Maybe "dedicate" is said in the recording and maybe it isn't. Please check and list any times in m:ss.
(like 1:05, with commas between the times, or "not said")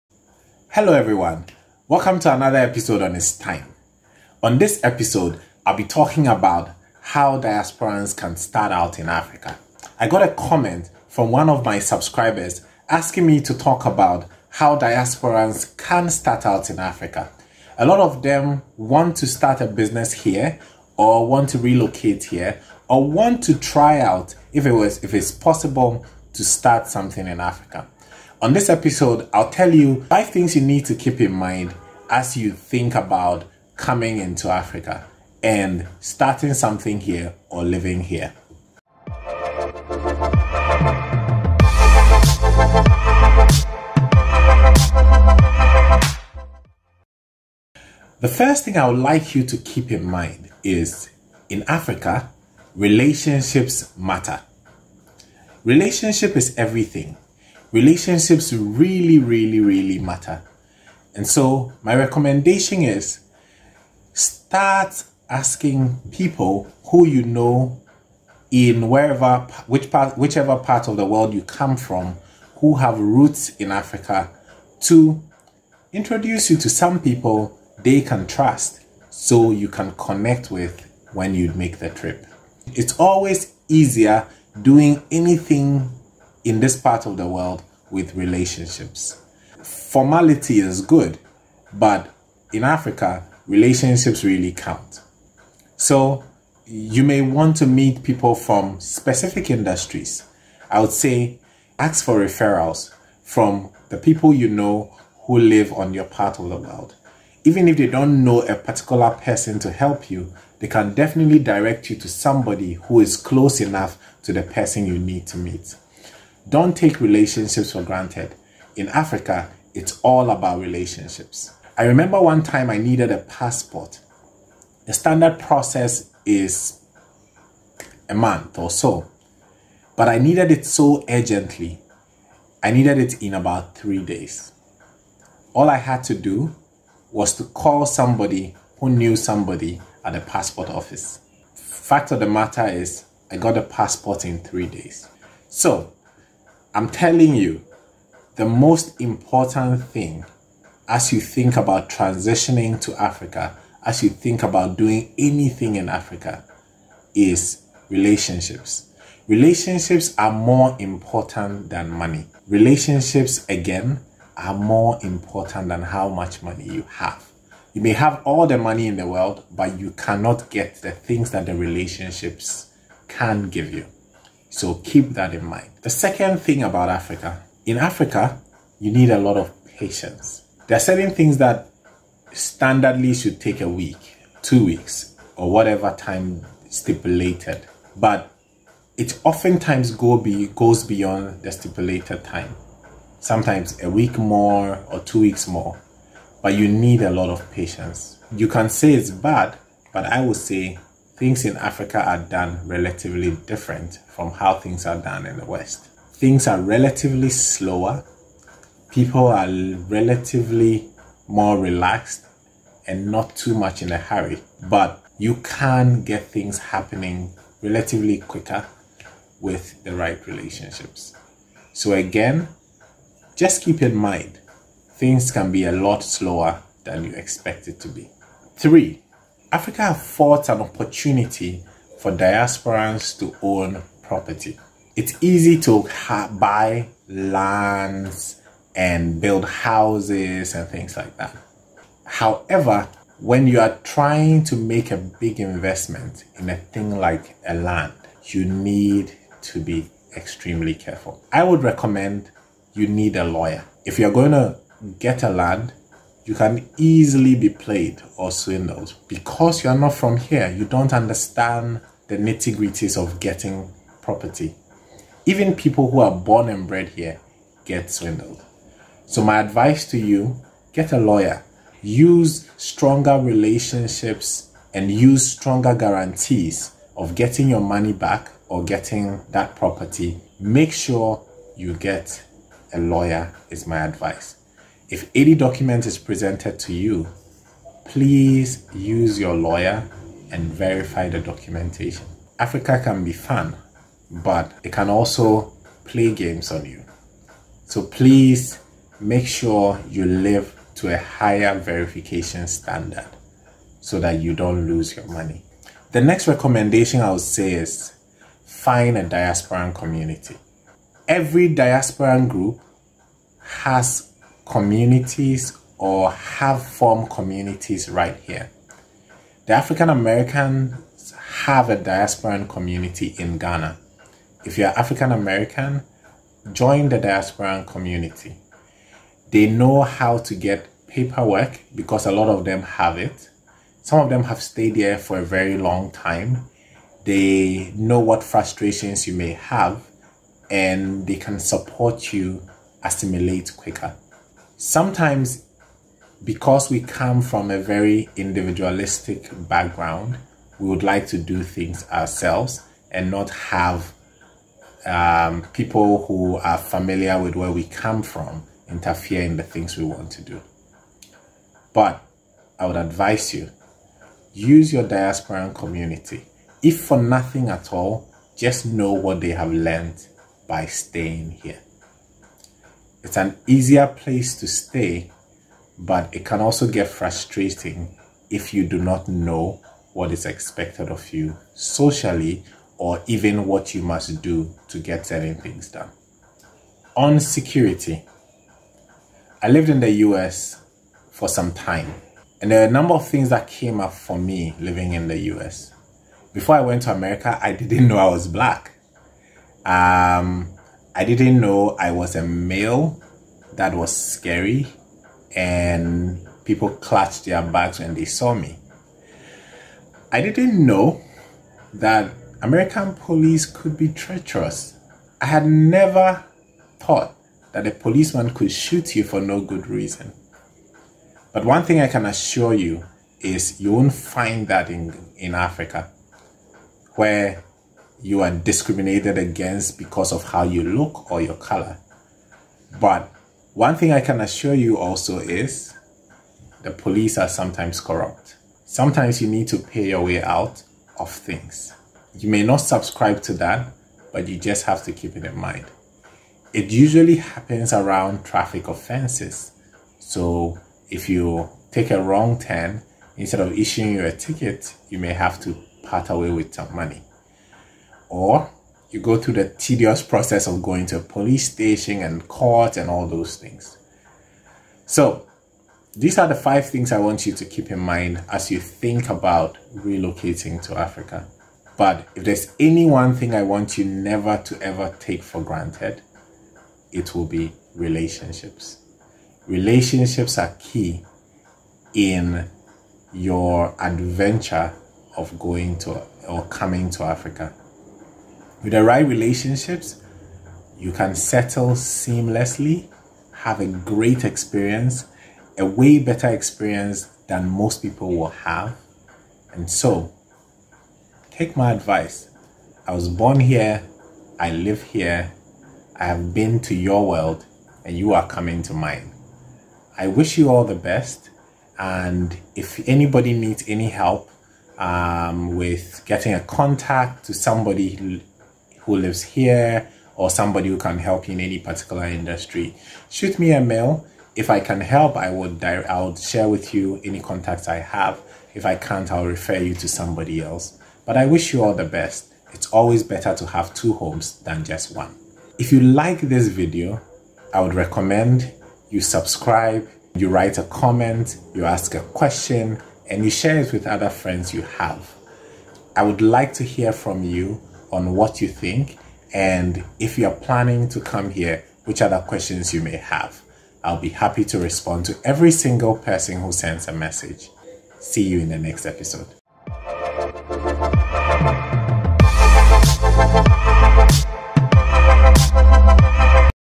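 not said.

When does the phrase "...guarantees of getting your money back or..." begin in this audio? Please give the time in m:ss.
4:35.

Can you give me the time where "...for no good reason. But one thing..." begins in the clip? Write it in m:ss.
6:59.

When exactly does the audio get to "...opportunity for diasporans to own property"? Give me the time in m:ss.
3:50.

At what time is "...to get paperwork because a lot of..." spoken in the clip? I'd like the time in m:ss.
5:30.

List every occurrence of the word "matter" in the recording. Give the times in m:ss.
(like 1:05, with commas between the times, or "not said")
0:53, 0:59, 2:22.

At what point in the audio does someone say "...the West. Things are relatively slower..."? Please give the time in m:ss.
3:25.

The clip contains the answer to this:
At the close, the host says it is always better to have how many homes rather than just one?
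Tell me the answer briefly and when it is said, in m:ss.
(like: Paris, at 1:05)
2, at 8:53.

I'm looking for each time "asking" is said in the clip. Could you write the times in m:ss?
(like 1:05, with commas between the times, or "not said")
0:12, 1:05.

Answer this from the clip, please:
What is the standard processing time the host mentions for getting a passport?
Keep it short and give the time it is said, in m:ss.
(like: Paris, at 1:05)
A month, at 2:08.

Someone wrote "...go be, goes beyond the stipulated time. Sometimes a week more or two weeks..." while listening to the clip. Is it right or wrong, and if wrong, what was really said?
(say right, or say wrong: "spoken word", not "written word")
right.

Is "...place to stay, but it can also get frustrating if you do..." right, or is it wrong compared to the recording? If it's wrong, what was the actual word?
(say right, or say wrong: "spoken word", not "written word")
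right.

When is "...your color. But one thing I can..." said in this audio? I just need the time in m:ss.
7:11.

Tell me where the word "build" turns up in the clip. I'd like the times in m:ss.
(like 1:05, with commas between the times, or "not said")
3:59.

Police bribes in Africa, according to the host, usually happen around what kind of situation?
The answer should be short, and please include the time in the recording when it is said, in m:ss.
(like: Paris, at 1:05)
Traffic offenses, at 7:28.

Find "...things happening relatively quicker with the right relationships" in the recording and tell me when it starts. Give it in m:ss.
3:36.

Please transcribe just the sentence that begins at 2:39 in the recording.
Relationships are more important than money.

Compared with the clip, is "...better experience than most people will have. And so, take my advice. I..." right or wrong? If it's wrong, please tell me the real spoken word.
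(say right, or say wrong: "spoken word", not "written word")
right.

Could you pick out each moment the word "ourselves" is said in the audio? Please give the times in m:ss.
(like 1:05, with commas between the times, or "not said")
5:51.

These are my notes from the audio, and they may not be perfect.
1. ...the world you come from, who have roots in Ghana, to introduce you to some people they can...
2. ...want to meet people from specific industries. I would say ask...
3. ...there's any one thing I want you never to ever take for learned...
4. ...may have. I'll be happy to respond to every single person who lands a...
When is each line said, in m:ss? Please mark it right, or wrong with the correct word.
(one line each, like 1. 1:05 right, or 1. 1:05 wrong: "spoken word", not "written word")
1. 1:10 wrong: "Africa", not "Ghana"
2. 1:37 right
3. 7:52 wrong: "granted", not "learned"
4. 9:12 wrong: "sends", not "lands".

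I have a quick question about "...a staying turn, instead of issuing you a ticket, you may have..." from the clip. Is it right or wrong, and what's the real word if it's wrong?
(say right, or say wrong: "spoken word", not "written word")
wrong: "wrong", not "staying".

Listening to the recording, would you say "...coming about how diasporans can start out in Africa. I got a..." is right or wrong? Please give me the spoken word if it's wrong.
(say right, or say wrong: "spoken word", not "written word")
wrong: "talking", not "coming".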